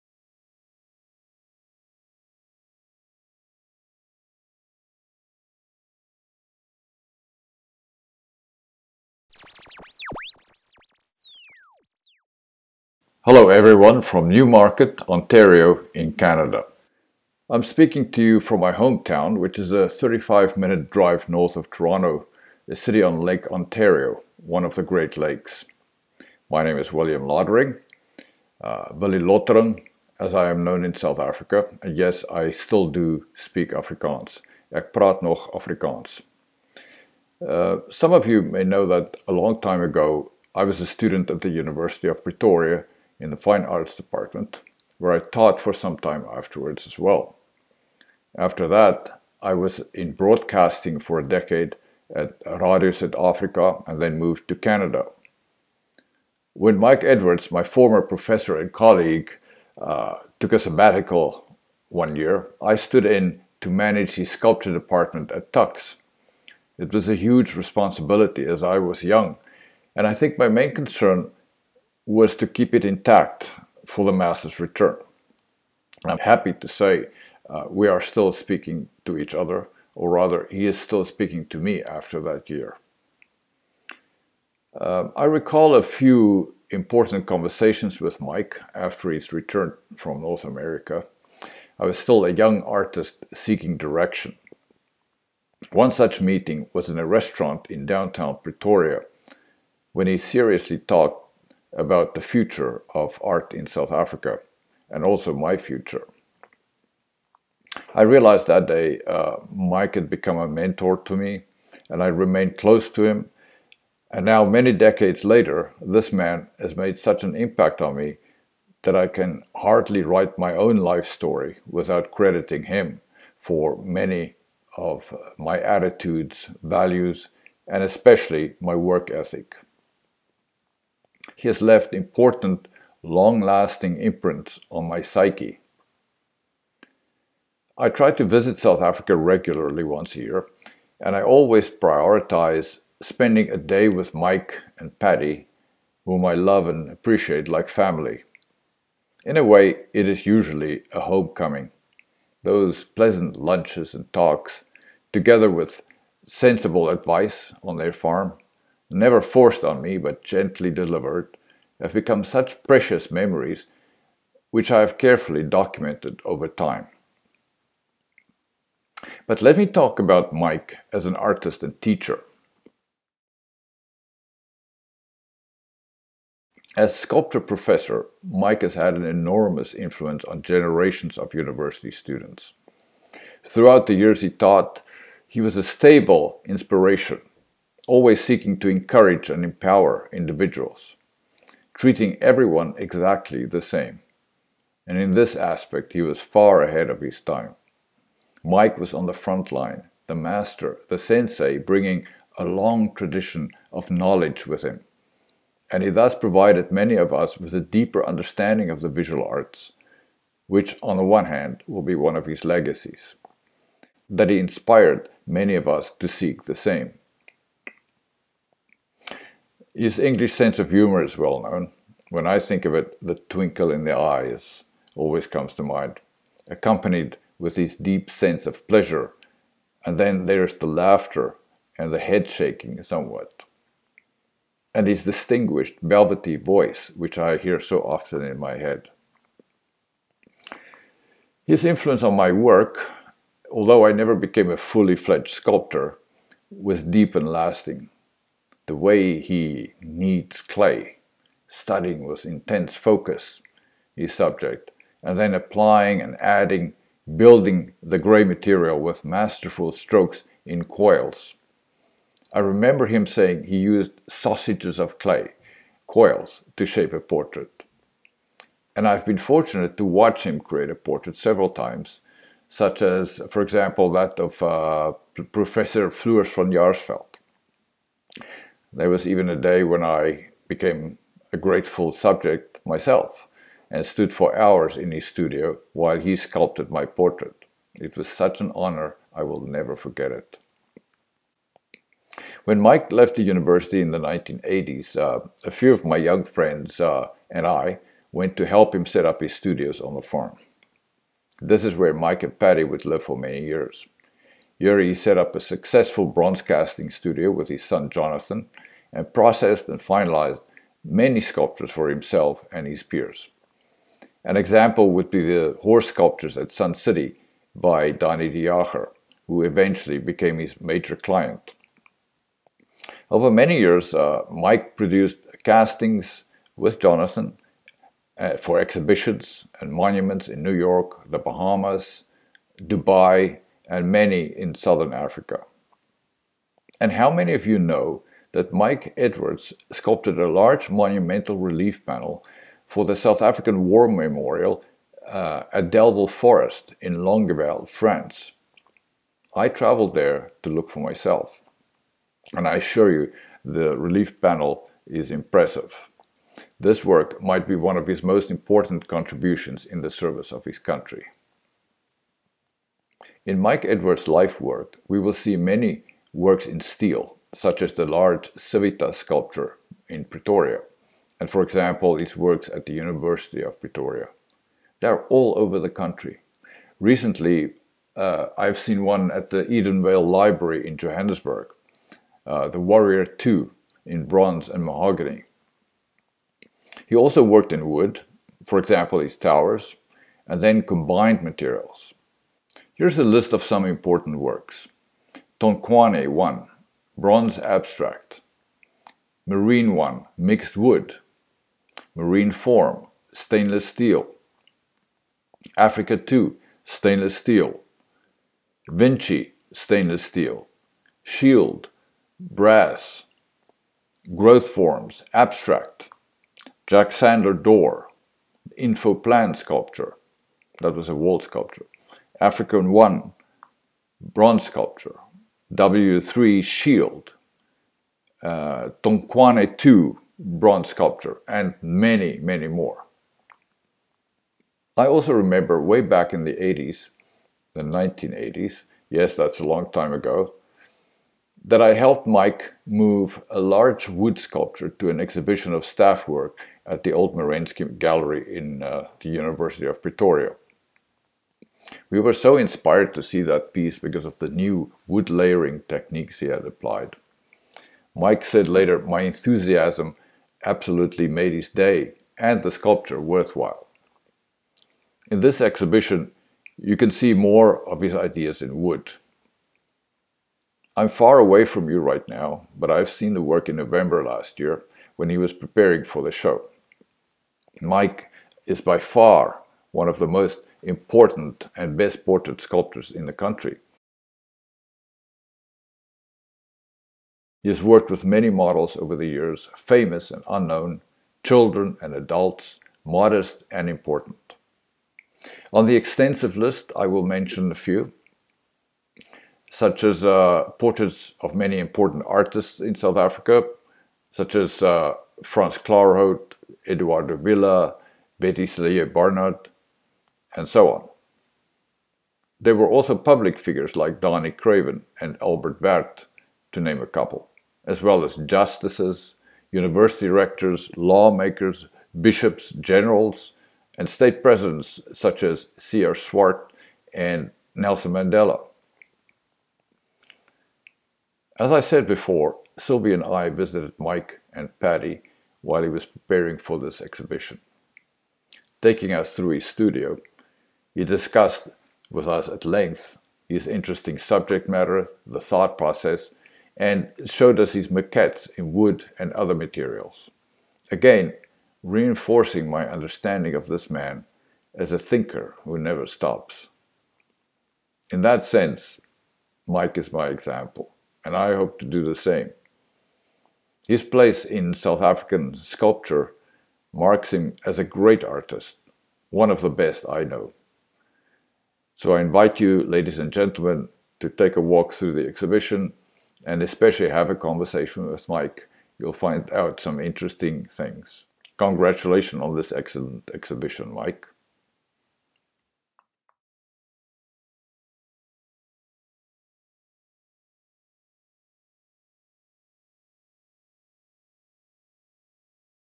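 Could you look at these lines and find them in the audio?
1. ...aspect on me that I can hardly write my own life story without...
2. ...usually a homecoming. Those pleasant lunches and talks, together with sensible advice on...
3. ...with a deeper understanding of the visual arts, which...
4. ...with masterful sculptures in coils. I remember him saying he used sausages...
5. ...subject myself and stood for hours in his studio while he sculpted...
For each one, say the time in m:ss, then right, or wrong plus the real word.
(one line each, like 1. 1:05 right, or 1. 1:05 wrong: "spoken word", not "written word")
1. 1:57 wrong: "impact", not "aspect"
2. 2:30 right
3. 3:27 right
4. 4:18 wrong: "strokes", not "sculptures"
5. 4:41 right.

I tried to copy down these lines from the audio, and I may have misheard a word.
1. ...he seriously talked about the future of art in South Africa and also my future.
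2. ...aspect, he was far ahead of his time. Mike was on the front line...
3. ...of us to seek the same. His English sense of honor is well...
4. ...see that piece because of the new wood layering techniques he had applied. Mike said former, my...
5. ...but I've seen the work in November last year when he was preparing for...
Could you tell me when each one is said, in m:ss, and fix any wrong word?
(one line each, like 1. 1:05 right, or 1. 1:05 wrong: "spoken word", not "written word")
1. 1:40 right
2. 3:15 right
3. 3:35 wrong: "humor", not "honor"
4. 7:33 wrong: "later", not "former"
5. 7:52 right.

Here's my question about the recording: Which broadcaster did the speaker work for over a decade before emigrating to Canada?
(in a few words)
Radio South Africa.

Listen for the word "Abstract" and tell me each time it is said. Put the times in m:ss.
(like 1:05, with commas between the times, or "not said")
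6:37, 6:55.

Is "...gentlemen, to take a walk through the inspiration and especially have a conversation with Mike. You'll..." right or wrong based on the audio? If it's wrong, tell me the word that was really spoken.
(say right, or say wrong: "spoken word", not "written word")
wrong: "exhibition", not "inspiration".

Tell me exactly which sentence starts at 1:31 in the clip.
I was still a young artist seeking direction.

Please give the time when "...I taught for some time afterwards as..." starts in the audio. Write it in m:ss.
0:45.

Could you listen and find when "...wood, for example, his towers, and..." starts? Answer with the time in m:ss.
6:27.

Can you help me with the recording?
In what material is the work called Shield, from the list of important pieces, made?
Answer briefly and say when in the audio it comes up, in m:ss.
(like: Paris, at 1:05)
Brass, at 6:52.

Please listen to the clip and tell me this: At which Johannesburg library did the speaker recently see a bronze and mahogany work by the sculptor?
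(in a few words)
Edenvale Library.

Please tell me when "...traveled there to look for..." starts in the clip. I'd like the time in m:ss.
5:49.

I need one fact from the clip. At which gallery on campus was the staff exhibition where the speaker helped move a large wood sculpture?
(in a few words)
Old Merensky Gallery.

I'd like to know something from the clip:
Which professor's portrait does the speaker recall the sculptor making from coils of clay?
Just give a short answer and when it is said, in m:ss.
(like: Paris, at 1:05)
Floors van Jaarsveld, at 4:35.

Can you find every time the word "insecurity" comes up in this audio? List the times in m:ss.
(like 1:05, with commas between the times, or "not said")
not said.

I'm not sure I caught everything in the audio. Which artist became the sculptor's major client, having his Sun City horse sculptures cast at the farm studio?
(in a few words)
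Danie de Jager.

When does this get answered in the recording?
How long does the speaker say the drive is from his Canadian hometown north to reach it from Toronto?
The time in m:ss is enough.
0:19.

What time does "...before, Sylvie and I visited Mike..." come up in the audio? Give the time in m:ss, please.
8:51.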